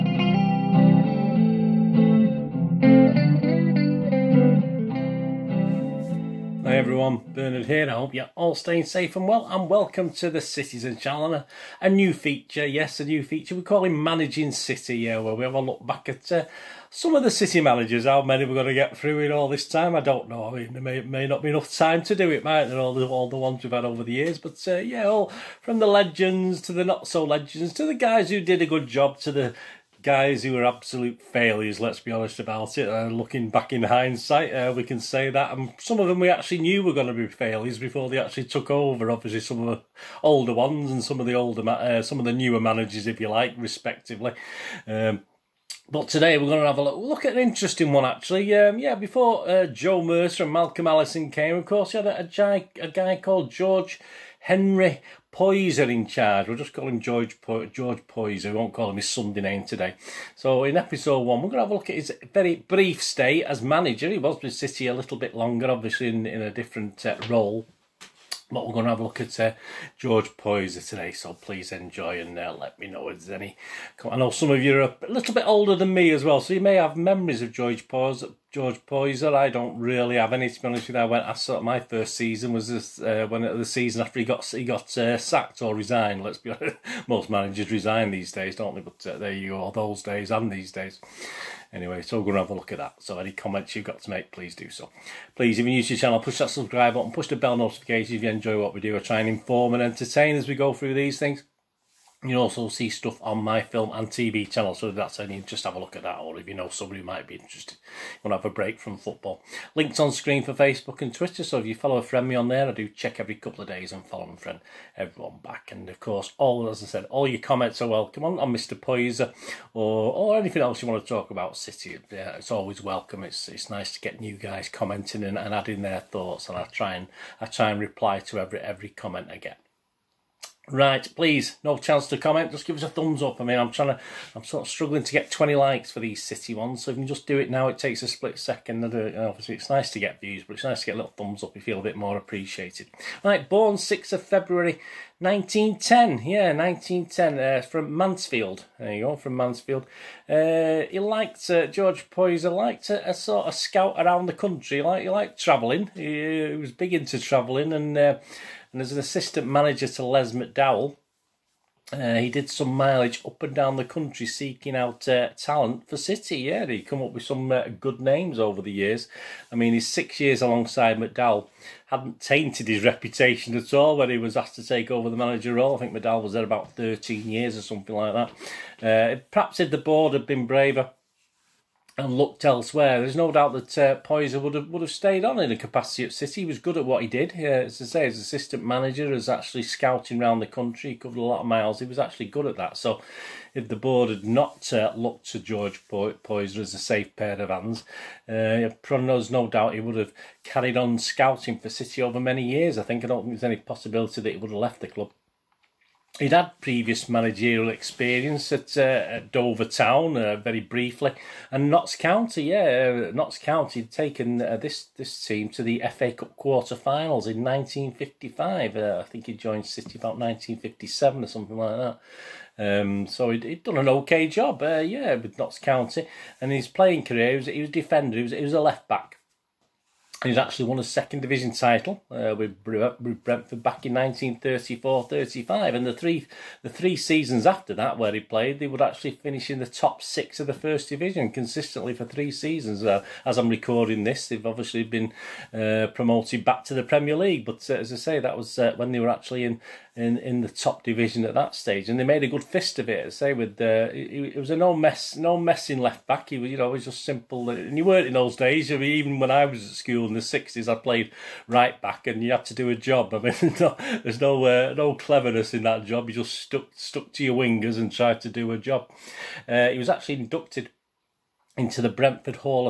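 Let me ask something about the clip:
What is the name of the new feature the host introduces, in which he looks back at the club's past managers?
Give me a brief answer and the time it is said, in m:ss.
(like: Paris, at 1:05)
Managing City, at 0:14.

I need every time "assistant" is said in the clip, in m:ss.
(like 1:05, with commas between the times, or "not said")
2:38, 3:08.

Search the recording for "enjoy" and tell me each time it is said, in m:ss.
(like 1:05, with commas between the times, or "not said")
1:11, 1:38.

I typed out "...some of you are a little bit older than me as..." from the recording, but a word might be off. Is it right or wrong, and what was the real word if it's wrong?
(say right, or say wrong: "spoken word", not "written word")
right.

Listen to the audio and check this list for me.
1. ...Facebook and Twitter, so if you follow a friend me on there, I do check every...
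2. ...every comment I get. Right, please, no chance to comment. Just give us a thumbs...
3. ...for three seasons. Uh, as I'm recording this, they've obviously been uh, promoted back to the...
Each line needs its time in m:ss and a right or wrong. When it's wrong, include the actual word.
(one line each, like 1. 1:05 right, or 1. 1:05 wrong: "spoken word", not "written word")
1. 1:50 right
2. 2:08 right
3. 4:01 right.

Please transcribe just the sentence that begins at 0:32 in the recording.
Uh, looking back in hindsight, uh, we can say that.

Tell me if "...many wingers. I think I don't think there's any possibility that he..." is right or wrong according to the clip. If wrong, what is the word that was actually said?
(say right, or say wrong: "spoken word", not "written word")
wrong: "years", not "wingers".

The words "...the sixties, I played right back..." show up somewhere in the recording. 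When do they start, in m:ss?
4:20.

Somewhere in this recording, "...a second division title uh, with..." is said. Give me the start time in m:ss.
3:50.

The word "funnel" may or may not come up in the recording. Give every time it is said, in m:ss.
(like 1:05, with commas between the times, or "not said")
not said.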